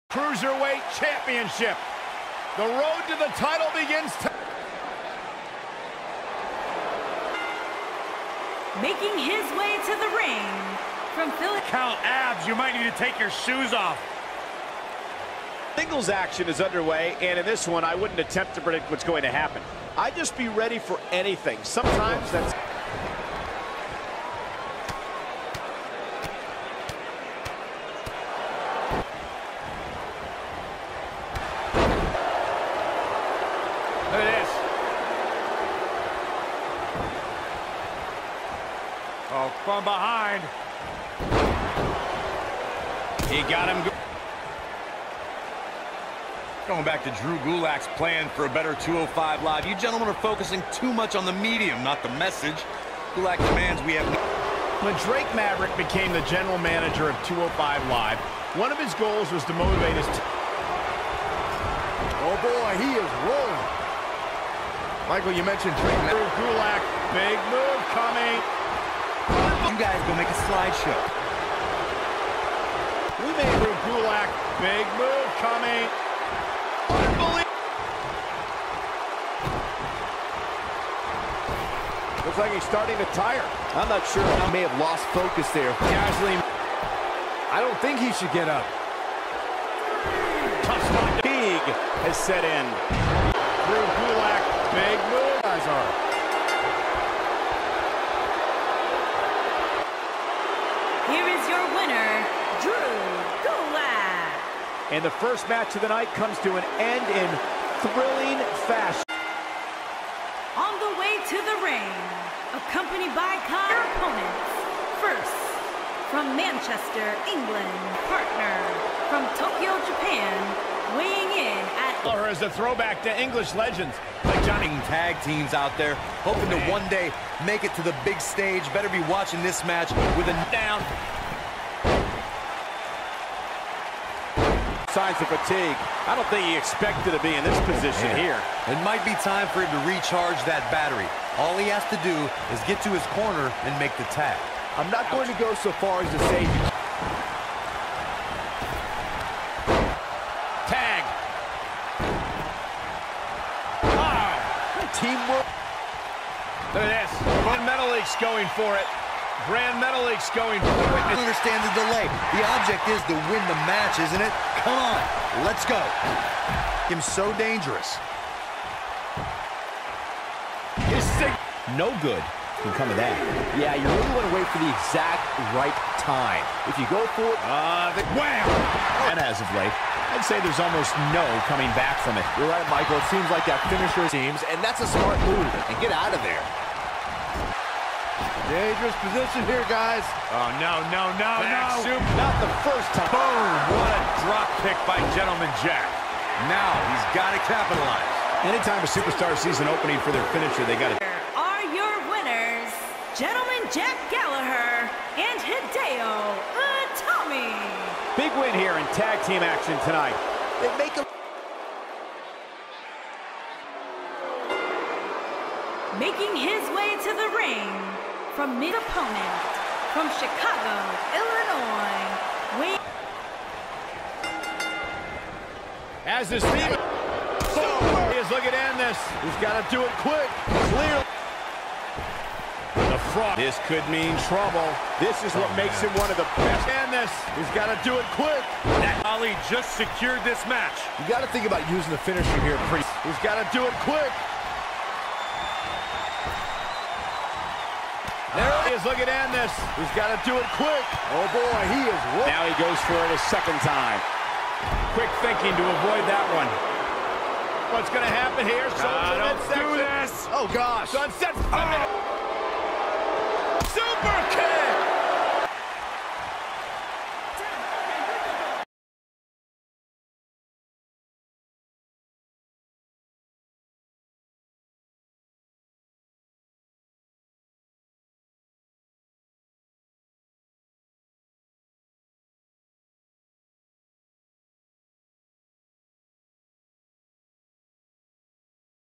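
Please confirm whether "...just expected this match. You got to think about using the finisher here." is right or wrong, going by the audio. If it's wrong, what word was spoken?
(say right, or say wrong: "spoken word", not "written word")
wrong: "secured", not "expected".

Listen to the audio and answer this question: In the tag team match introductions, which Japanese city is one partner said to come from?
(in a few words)
Tokyo.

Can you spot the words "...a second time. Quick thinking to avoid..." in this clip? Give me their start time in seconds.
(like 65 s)
253 s.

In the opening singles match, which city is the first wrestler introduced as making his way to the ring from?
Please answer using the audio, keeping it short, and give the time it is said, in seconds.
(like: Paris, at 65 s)
Philadelphia, at 11 s.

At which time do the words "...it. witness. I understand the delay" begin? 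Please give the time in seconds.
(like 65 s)
160 s.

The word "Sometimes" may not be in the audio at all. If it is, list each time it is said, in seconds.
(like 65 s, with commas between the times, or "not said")
21 s.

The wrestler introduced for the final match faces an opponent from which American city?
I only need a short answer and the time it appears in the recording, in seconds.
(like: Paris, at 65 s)
Chicago, at 220 s.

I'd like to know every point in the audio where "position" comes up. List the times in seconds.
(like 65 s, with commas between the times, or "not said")
137 s, 189 s.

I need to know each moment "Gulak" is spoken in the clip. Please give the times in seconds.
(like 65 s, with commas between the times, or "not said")
47 s, 53 s, 66 s, 73 s, 94 s, 103 s.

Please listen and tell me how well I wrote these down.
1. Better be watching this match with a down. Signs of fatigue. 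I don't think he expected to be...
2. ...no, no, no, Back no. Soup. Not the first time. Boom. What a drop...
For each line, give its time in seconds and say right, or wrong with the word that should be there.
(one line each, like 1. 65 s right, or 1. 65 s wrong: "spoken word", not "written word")
1. 128 s right
2. 190 s right.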